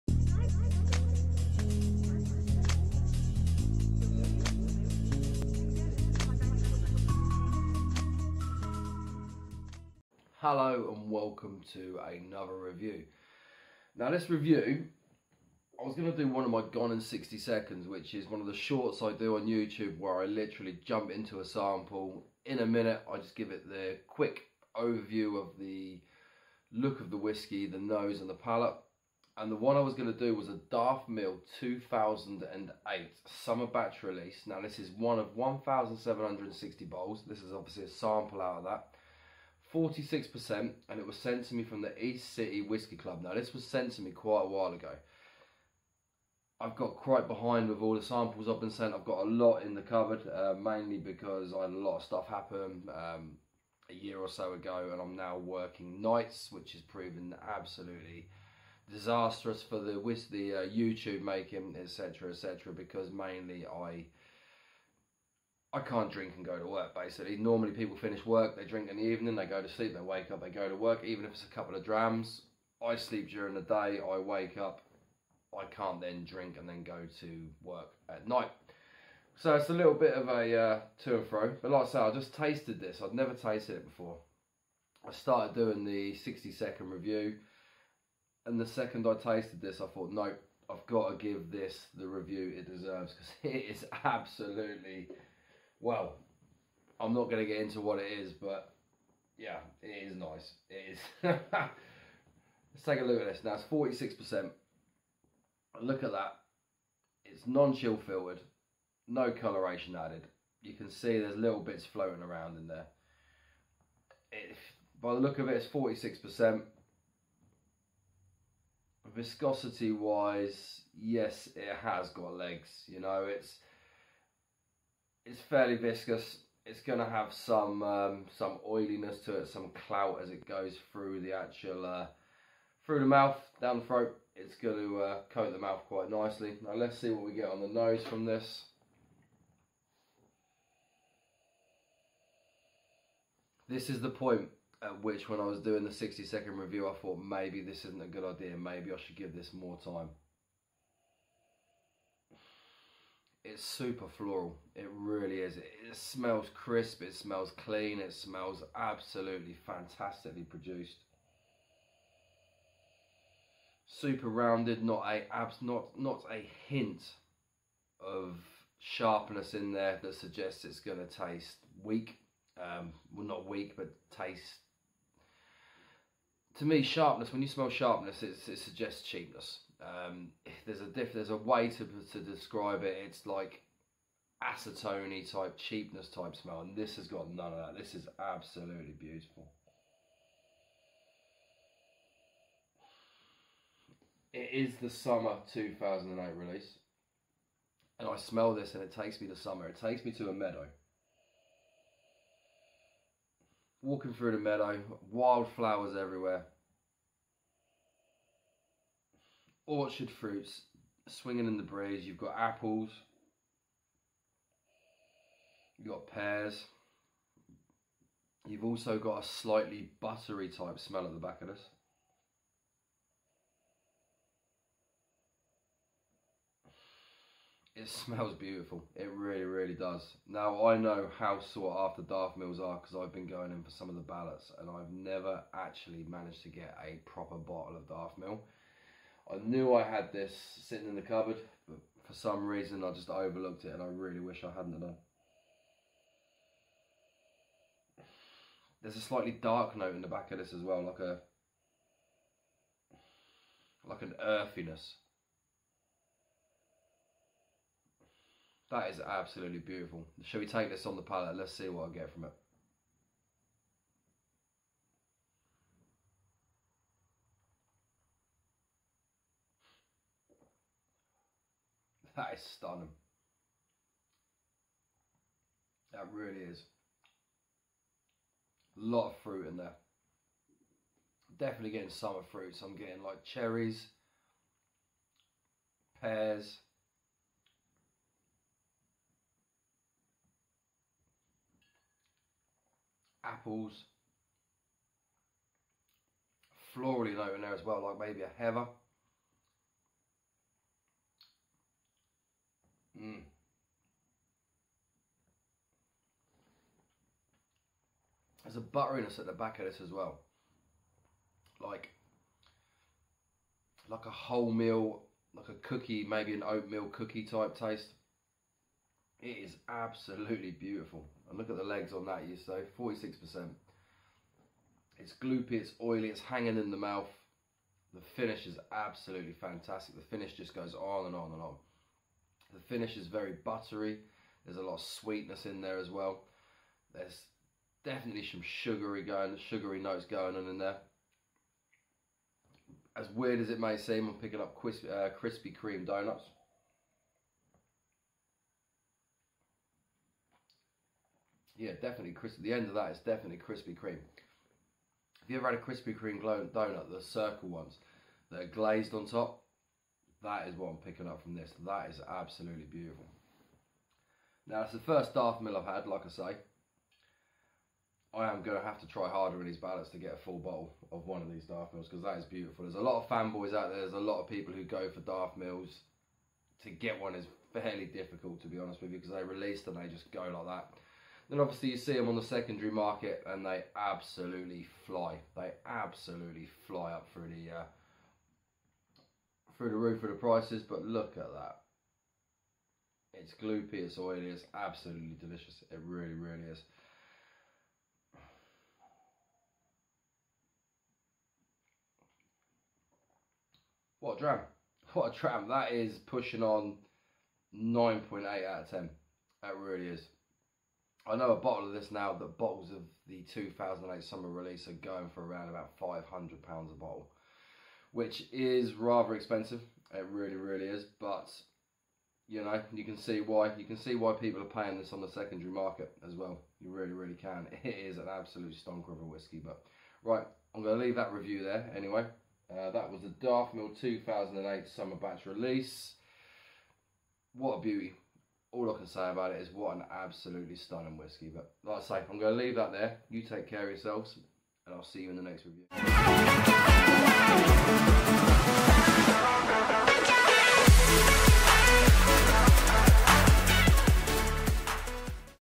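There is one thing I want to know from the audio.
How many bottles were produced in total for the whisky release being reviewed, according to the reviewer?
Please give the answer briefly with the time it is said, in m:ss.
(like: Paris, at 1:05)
1,760, at 0:35.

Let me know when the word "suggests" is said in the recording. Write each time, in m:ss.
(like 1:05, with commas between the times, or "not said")
2:50, 2:58.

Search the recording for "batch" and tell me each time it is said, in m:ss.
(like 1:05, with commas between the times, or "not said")
0:33, 7:14.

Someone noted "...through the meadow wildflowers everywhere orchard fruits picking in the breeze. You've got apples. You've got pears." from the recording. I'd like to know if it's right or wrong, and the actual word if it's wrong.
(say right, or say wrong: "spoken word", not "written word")
wrong: "swinging", not "picking".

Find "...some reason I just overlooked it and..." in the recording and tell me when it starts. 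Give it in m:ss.
4:02.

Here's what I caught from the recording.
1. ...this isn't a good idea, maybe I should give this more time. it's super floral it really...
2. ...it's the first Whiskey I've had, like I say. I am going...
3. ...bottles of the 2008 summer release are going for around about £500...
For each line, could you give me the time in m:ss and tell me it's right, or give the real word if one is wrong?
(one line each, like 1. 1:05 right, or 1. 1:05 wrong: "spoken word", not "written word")
1. 2:27 right
2. 6:04 wrong: "Daftmill", not "Whiskey"
3. 6:52 right.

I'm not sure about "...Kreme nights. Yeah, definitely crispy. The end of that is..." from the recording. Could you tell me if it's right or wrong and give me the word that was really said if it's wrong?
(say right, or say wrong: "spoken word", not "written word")
wrong: "donuts", not "nights".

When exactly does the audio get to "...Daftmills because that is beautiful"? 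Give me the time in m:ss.
6:11.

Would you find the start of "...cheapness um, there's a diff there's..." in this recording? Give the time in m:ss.
2:59.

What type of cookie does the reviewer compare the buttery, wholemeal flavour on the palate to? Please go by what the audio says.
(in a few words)
Oatmeal cookie.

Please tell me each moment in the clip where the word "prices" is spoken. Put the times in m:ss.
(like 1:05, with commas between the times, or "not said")
6:30.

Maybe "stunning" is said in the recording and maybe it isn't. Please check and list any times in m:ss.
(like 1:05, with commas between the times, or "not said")
4:32, 7:20.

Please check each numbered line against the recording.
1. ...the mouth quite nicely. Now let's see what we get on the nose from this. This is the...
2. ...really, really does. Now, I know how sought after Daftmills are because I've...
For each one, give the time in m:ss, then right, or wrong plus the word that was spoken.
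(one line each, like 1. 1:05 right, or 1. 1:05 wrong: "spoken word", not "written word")
1. 2:15 right
2. 3:49 right.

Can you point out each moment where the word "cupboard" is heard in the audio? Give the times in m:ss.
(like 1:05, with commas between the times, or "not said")
0:49, 4:01.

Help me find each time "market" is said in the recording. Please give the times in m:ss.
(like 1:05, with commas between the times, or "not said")
6:22, 7:05.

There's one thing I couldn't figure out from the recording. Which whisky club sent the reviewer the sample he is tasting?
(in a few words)
East City Whiskey Club.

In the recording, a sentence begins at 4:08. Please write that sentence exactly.
There's a slightly dark note in the back of this as well, like a like an earthiness.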